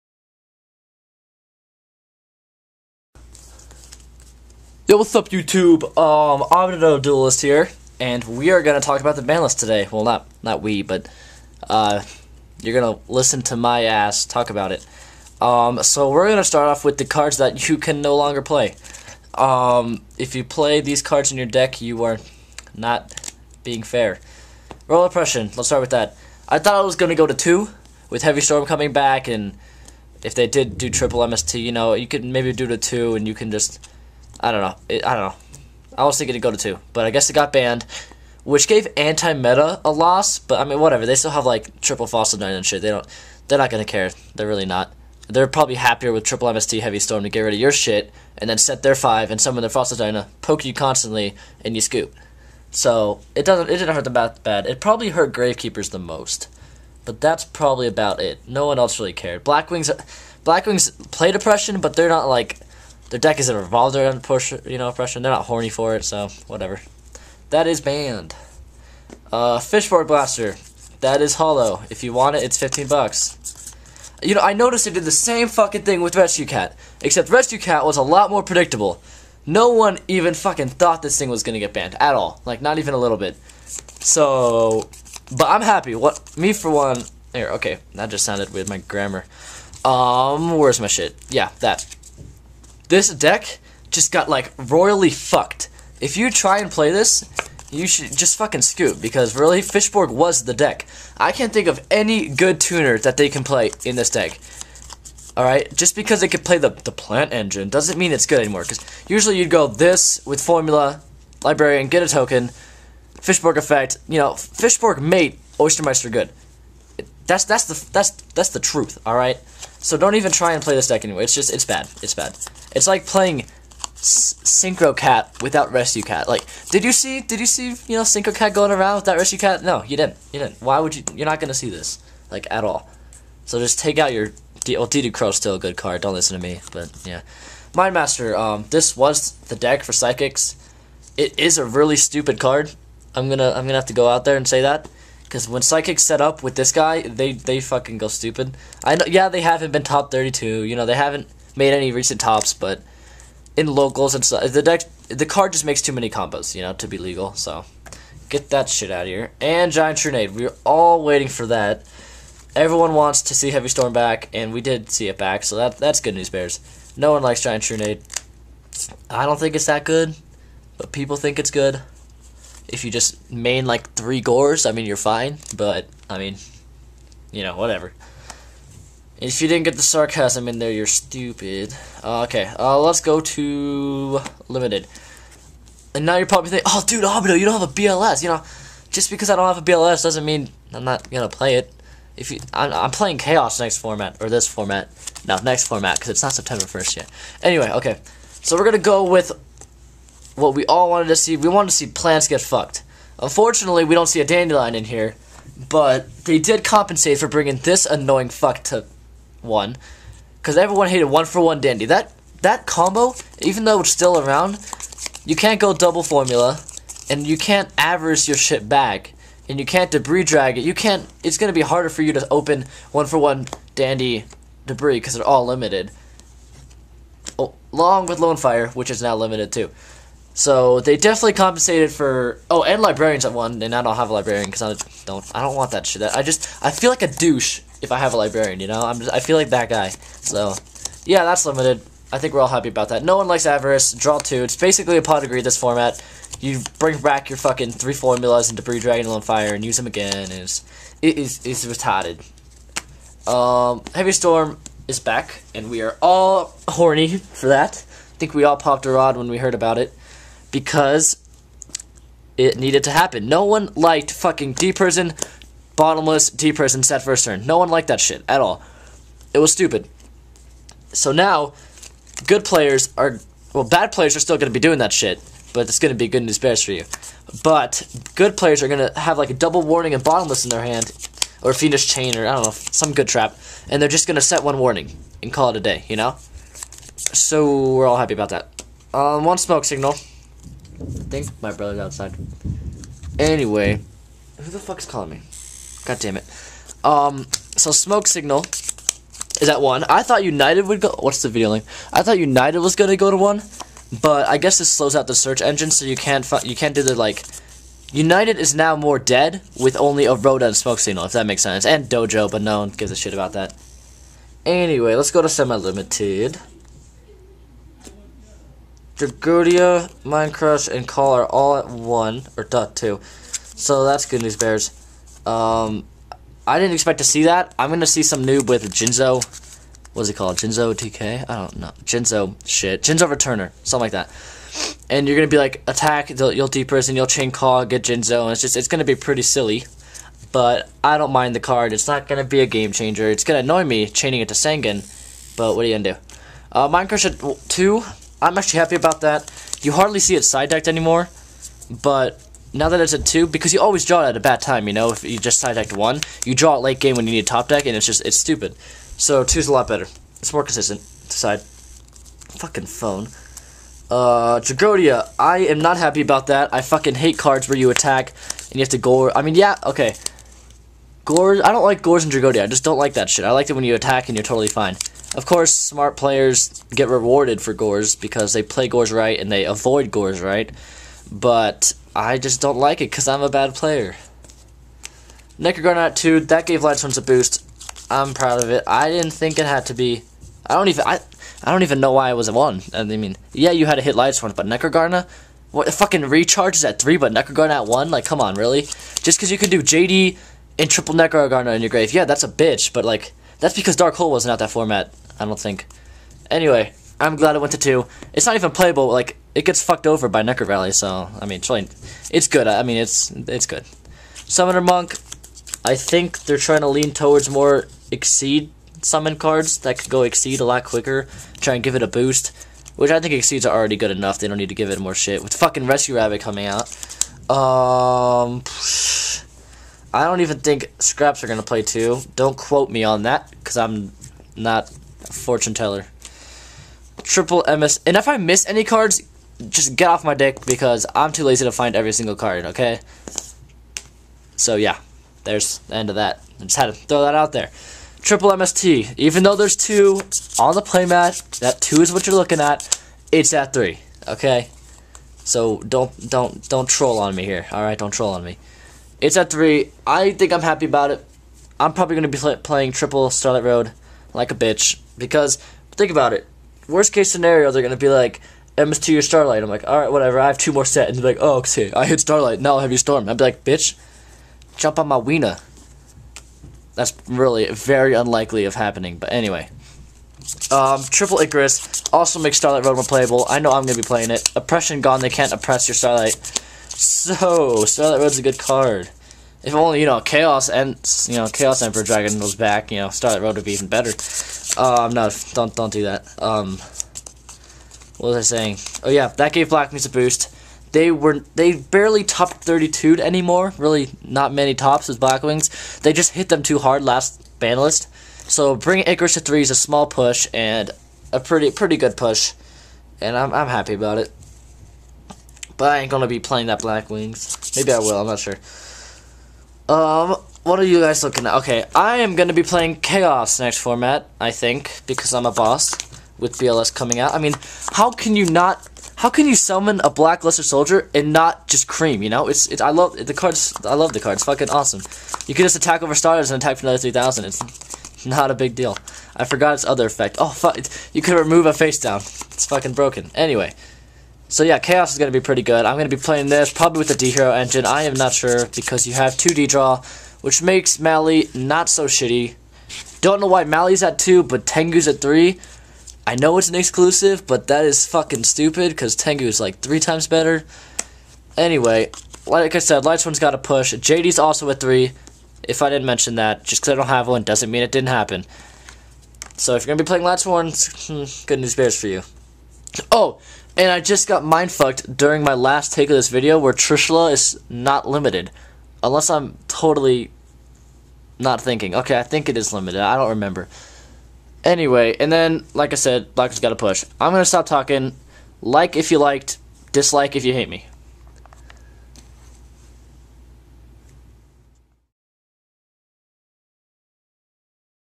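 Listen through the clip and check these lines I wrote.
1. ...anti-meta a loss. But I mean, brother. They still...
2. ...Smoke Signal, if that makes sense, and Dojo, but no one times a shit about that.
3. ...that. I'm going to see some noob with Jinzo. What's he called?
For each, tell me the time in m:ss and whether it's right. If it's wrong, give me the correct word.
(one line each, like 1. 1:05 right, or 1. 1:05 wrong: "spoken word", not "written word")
1. 0:38 wrong: "whatever", not "brother"
2. 5:10 wrong: "gives", not "times"
3. 5:27 right.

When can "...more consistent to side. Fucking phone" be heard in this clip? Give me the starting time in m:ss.
6:00.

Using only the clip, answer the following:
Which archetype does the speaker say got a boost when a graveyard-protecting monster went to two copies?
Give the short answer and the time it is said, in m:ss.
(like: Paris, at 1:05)
Lightsworns, at 6:26.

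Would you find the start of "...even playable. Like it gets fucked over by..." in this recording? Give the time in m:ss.
6:48.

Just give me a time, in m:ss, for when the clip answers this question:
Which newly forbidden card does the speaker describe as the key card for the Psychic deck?
2:17.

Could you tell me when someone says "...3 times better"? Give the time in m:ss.
9:19.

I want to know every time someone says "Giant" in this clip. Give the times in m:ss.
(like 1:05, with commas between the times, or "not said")
2:39, 2:47.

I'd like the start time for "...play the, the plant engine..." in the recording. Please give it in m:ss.
1:46.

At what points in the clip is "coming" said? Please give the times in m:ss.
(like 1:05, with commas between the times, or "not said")
0:28, 7:06, 8:46.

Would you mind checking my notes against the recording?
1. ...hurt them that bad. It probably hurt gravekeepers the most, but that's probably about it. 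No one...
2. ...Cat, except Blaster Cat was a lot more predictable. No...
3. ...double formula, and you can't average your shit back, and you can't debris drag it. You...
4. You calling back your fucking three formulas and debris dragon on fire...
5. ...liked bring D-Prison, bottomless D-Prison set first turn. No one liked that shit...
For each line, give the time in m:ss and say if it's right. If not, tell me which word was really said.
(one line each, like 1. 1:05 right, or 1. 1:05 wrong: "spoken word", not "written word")
1. 0:53 right
2. 1:16 wrong: "Rescue", not "Blaster"
3. 3:35 right
4. 4:06 wrong: "bring", not "calling"
5. 4:23 wrong: "fucking", not "bring".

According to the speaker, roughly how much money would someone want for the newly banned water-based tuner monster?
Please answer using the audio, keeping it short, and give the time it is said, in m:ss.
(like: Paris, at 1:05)
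15 bucks, at 1:12.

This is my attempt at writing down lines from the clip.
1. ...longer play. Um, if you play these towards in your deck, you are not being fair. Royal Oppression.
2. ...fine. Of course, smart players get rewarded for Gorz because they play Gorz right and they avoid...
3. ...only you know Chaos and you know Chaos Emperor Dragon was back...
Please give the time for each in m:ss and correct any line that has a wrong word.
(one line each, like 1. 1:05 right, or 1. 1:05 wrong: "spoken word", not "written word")
1. 0:18 wrong: "cards", not "towards"
2. 6:14 right
3. 8:09 right.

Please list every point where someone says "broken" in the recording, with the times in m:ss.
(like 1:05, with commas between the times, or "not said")
9:02.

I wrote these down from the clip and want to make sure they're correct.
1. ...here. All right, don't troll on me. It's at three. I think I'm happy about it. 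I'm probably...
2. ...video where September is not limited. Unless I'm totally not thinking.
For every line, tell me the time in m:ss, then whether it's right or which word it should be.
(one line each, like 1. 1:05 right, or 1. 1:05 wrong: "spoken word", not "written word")
1. 7:37 right
2. 9:36 wrong: "Trishula", not "September".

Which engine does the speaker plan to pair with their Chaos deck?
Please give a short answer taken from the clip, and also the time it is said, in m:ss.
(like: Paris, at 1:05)
D-Hero engine, at 9:06.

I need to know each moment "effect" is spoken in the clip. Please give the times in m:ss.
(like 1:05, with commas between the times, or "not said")
1:53, 8:59.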